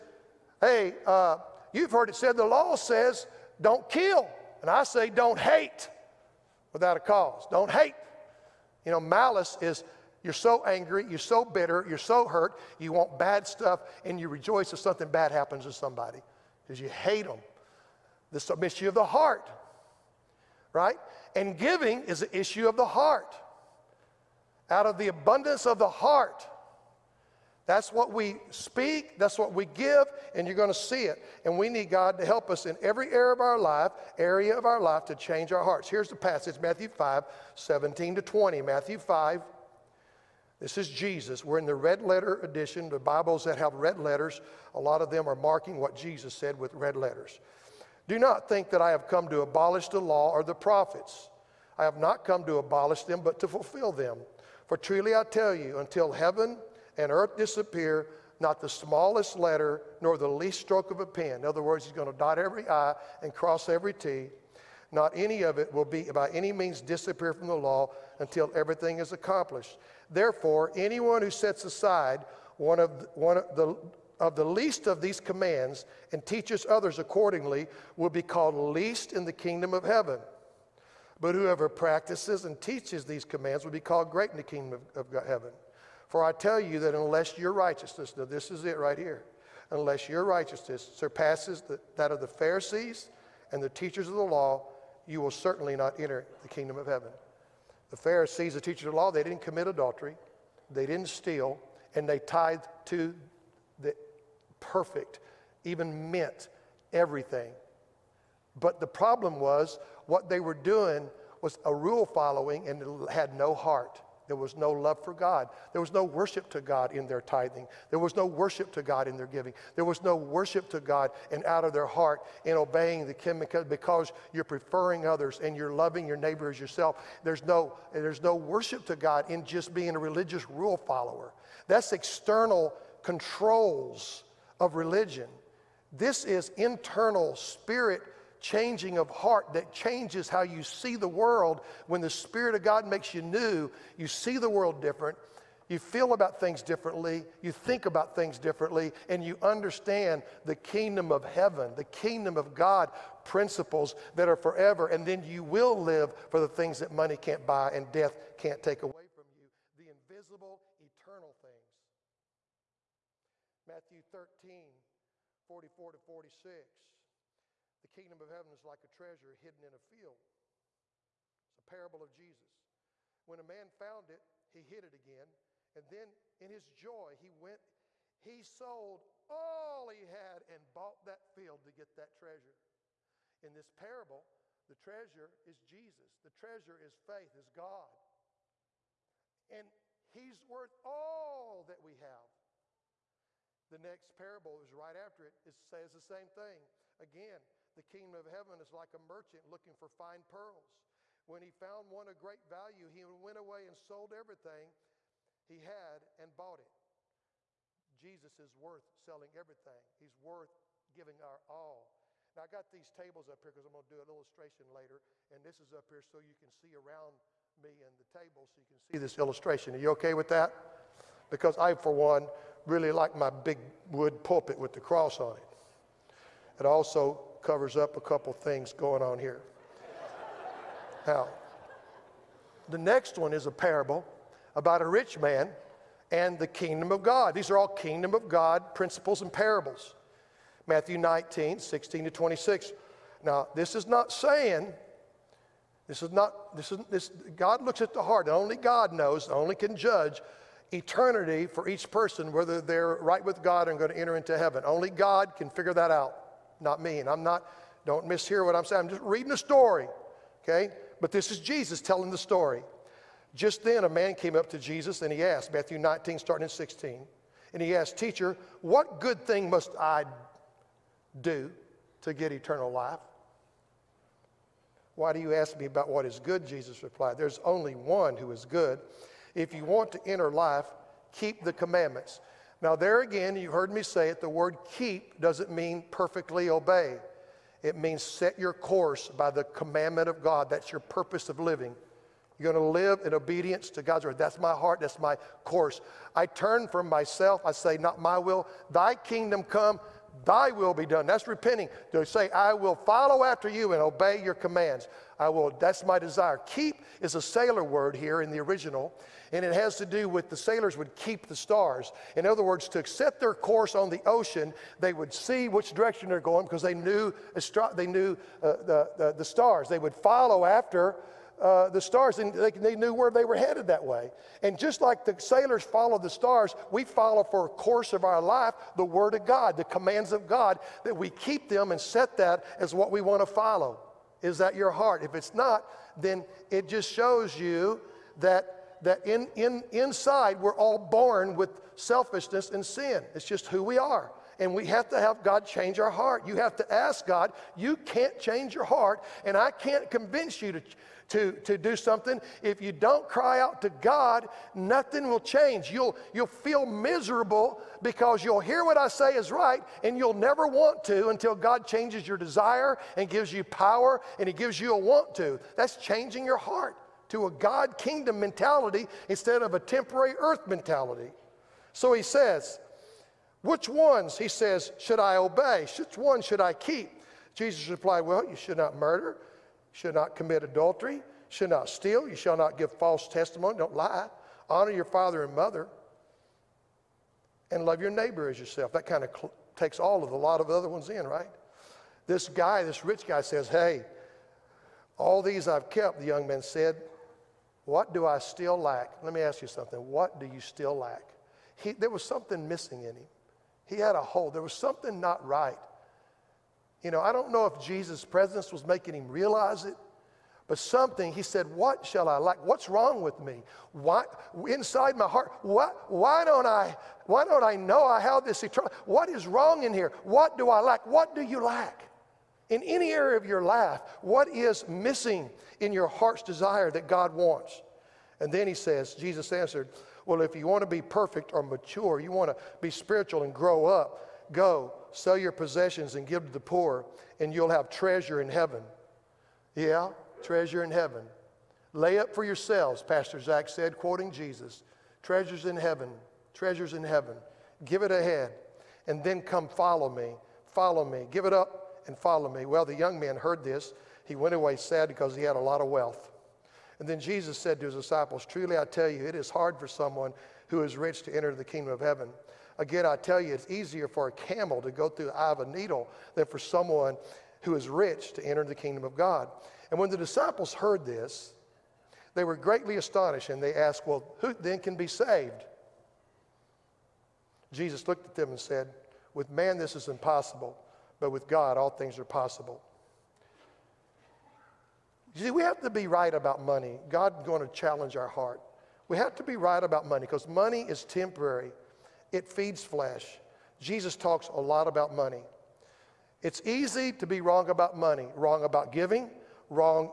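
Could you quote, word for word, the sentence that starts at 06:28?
That kind of cl- takes all of the lot of the other ones in, right?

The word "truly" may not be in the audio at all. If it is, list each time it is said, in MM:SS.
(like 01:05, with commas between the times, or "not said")
00:54, 07:38.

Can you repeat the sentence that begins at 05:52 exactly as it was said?
If you don't cry out to God, nothing will change.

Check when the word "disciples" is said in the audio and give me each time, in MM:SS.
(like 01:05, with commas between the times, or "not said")
07:37, 07:49.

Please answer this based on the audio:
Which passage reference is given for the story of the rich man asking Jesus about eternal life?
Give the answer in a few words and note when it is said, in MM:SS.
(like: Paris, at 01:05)
Matthew 19:16-26, at 04:00.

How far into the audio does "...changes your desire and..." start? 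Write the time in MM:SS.
06:01.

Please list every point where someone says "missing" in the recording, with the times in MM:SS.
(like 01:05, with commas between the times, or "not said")
06:42, 07:04.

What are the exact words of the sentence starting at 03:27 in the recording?
Jesus is worth selling everything, he's worth giving our all.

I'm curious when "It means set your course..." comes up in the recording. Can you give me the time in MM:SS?
04:47.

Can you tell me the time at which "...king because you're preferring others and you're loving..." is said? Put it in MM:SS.
02:03.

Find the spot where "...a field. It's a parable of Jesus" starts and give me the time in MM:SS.
02:49.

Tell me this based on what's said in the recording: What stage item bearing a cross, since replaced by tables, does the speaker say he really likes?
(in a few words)
Wood pulpit.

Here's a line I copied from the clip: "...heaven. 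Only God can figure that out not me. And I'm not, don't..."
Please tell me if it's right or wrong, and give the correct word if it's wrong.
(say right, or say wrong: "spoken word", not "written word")
right.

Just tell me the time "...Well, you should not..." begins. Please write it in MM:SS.
06:18.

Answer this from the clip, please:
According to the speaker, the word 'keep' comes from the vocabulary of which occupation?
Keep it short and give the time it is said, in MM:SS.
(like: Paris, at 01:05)
Sailor, at 05:07.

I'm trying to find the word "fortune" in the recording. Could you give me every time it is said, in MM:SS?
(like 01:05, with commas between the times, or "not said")
not said.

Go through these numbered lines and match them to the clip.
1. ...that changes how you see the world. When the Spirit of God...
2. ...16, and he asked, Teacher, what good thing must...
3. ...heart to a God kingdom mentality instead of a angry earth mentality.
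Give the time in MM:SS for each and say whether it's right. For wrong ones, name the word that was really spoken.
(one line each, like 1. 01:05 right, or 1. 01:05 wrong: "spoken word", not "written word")
1. 02:19 right
2. 04:26 right
3. 06:06 wrong: "temporary", not "angry".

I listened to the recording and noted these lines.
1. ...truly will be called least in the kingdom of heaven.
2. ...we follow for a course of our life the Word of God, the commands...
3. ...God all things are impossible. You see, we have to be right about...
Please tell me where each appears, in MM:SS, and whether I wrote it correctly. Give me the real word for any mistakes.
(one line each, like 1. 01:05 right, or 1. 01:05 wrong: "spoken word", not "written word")
1. 01:16 wrong: "accordingly", not "truly"
2. 05:26 right
3. 08:01 wrong: "possible", not "impossible".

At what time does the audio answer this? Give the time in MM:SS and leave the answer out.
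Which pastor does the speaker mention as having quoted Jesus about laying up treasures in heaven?
07:22.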